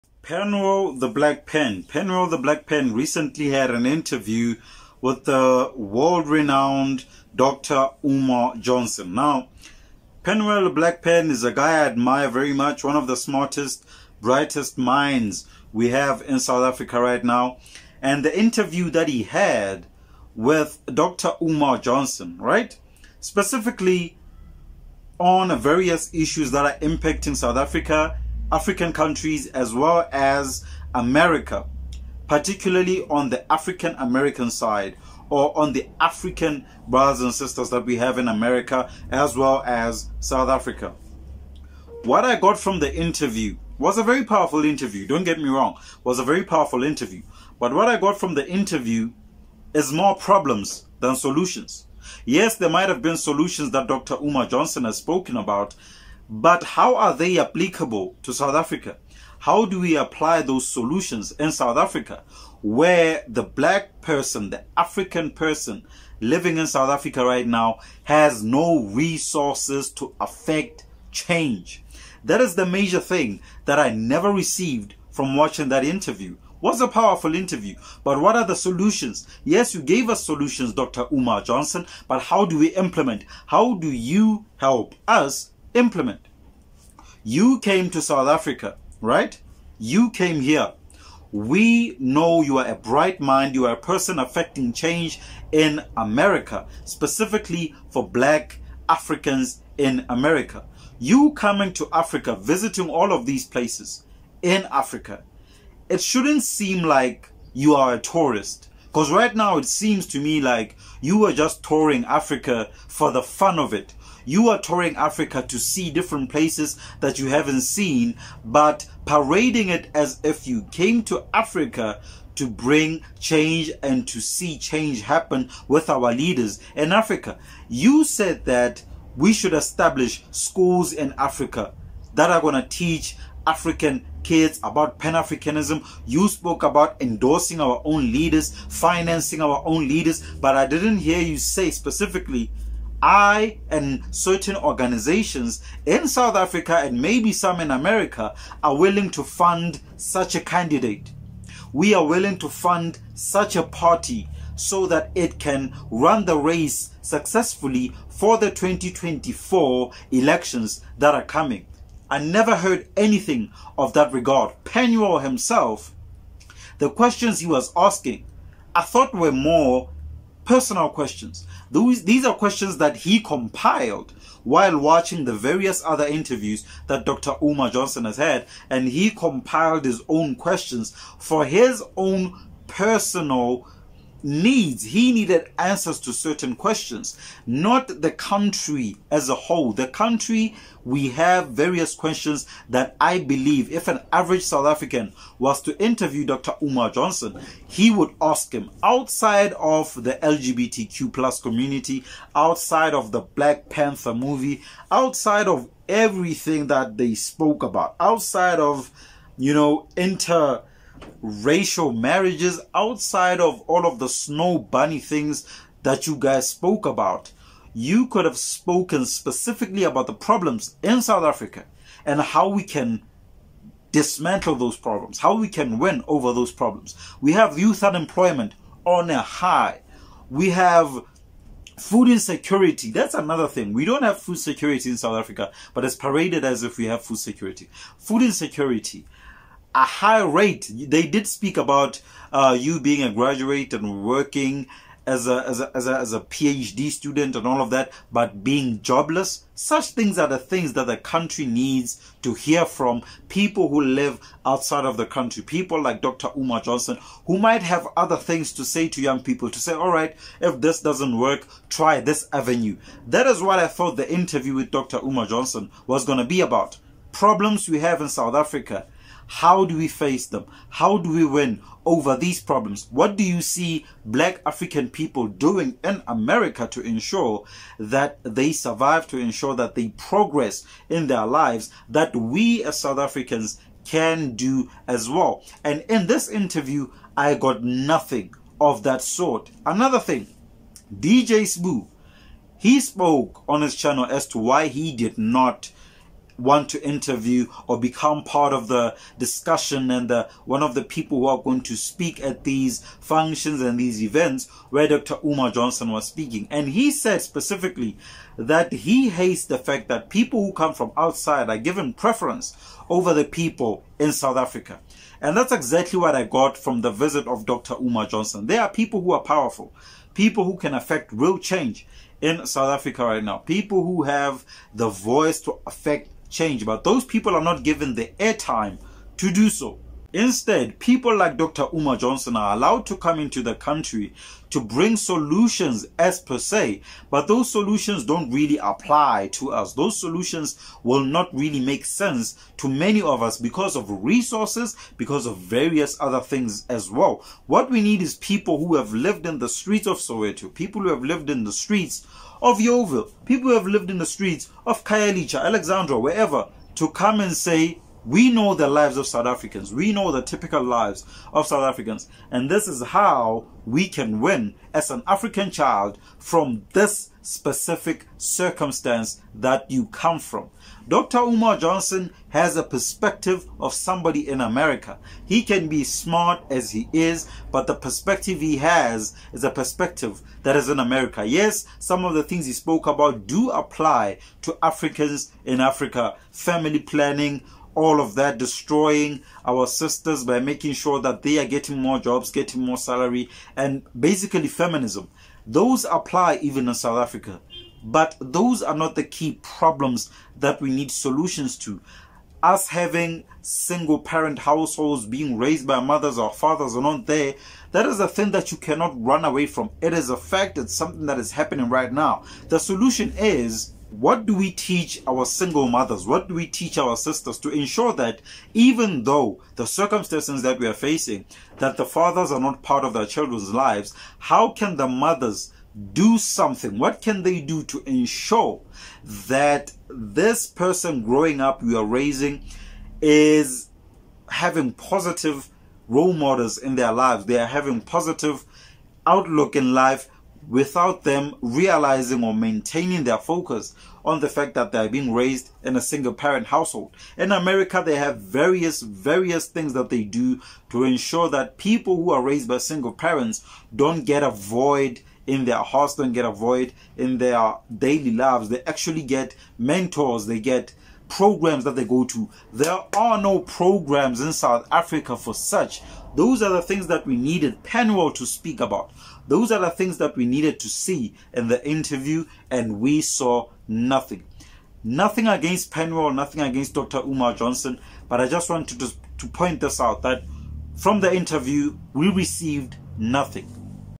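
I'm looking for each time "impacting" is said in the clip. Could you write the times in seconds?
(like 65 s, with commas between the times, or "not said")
26 s.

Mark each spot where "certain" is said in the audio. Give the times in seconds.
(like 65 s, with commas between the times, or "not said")
144 s, 186 s.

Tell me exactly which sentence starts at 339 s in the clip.
Those solutions will not really make sense to many of us because of resources, because of various other things as well.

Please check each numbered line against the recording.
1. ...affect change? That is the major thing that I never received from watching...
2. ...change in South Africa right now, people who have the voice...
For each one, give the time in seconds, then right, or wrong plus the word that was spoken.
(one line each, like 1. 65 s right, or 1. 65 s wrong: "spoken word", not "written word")
1. 70 s right
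2. 321 s right.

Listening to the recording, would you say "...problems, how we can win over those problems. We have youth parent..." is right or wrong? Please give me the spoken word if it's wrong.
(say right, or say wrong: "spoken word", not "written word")
wrong: "unemployment", not "parent".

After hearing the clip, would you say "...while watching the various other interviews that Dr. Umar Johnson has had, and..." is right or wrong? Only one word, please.
right.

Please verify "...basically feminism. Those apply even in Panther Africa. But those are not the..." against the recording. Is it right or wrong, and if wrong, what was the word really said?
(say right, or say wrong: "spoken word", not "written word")
wrong: "South", not "Panther".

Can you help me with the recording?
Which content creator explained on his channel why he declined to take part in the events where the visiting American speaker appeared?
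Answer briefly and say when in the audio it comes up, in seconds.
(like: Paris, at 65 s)
DJ Spoo, at 290 s.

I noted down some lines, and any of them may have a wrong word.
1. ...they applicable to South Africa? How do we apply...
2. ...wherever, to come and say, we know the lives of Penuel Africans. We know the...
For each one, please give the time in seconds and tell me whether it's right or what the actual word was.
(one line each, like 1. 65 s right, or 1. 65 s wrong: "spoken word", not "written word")
1. 57 s right
2. 355 s wrong: "South", not "Penuel".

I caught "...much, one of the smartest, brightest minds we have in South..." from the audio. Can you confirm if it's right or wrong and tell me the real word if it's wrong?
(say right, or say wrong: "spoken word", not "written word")
right.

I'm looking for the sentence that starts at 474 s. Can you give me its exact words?
Nothing against Penuel, nothing against Dr.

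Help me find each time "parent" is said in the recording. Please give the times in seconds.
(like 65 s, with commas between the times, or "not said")
403 s, 446 s, 452 s.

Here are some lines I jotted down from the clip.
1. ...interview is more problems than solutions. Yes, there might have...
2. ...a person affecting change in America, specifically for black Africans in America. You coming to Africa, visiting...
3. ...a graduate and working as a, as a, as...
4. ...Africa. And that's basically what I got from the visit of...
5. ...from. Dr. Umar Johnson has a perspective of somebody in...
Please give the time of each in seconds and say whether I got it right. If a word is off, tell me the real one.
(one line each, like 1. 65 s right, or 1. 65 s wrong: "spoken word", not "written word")
1. 48 s right
2. 93 s right
3. 243 s right
4. 314 s wrong: "exactly", not "basically"
5. 370 s right.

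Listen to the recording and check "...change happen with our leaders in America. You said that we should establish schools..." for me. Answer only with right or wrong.
wrong.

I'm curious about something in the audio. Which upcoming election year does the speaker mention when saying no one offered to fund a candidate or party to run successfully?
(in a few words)
2024.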